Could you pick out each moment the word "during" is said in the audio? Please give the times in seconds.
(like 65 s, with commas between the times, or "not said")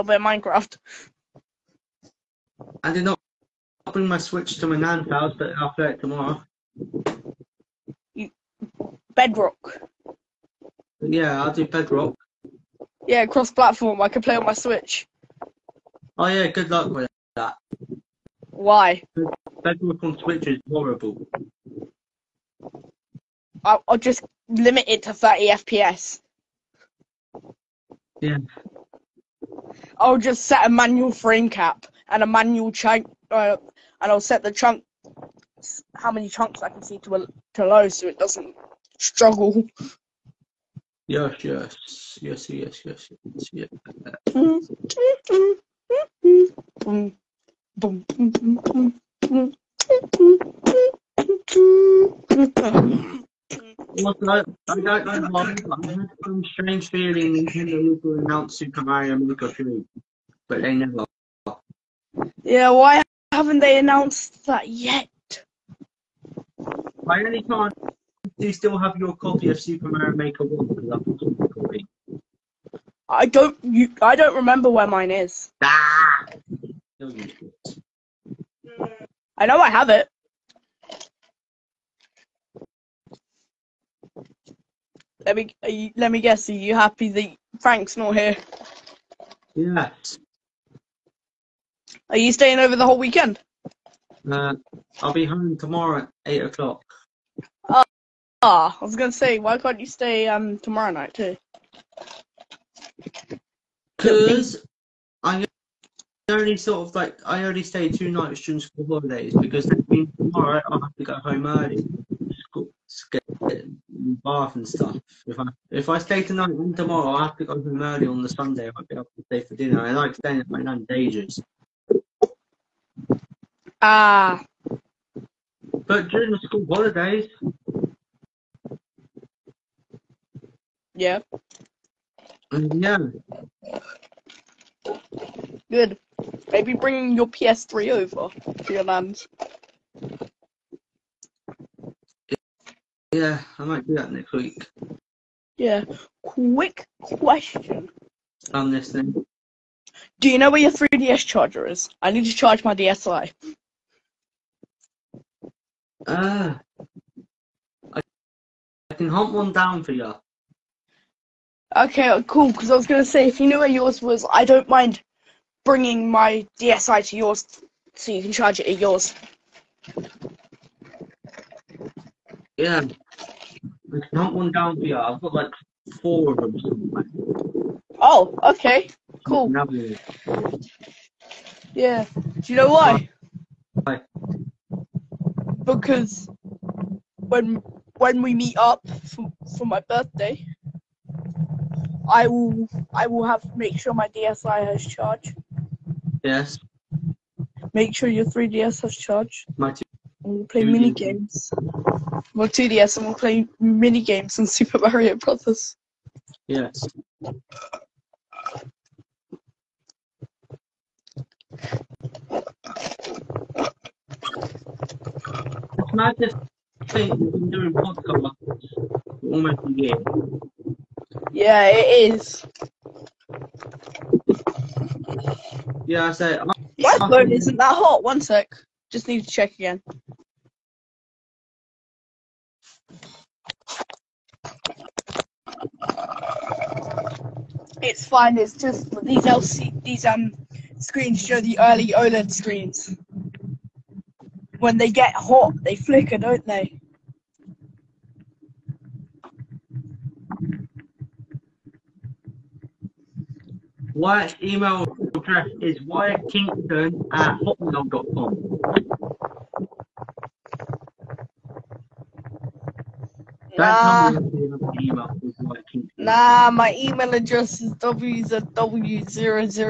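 108 s, 126 s.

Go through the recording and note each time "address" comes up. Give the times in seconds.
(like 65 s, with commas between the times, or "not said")
255 s, 267 s.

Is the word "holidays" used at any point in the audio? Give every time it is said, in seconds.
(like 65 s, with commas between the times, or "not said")
108 s, 126 s.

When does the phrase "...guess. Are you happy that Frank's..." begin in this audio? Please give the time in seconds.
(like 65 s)
86 s.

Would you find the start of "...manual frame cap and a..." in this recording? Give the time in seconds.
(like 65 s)
30 s.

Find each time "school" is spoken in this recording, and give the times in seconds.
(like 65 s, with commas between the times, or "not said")
108 s, 126 s.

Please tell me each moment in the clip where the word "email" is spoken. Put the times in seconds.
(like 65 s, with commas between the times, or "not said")
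254 s, 266 s.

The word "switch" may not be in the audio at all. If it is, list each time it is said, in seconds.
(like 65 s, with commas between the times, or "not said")
4 s, 14 s, 20 s.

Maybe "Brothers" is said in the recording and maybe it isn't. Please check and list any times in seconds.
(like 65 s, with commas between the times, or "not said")
205 s.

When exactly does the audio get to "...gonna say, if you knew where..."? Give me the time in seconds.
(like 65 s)
162 s.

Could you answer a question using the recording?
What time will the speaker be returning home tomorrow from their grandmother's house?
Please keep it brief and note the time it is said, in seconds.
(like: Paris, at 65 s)
8 o'clock, at 96 s.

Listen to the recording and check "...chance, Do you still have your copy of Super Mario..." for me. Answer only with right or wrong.
right.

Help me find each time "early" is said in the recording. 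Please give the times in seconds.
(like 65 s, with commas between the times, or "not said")
111 s, 117 s, 241 s.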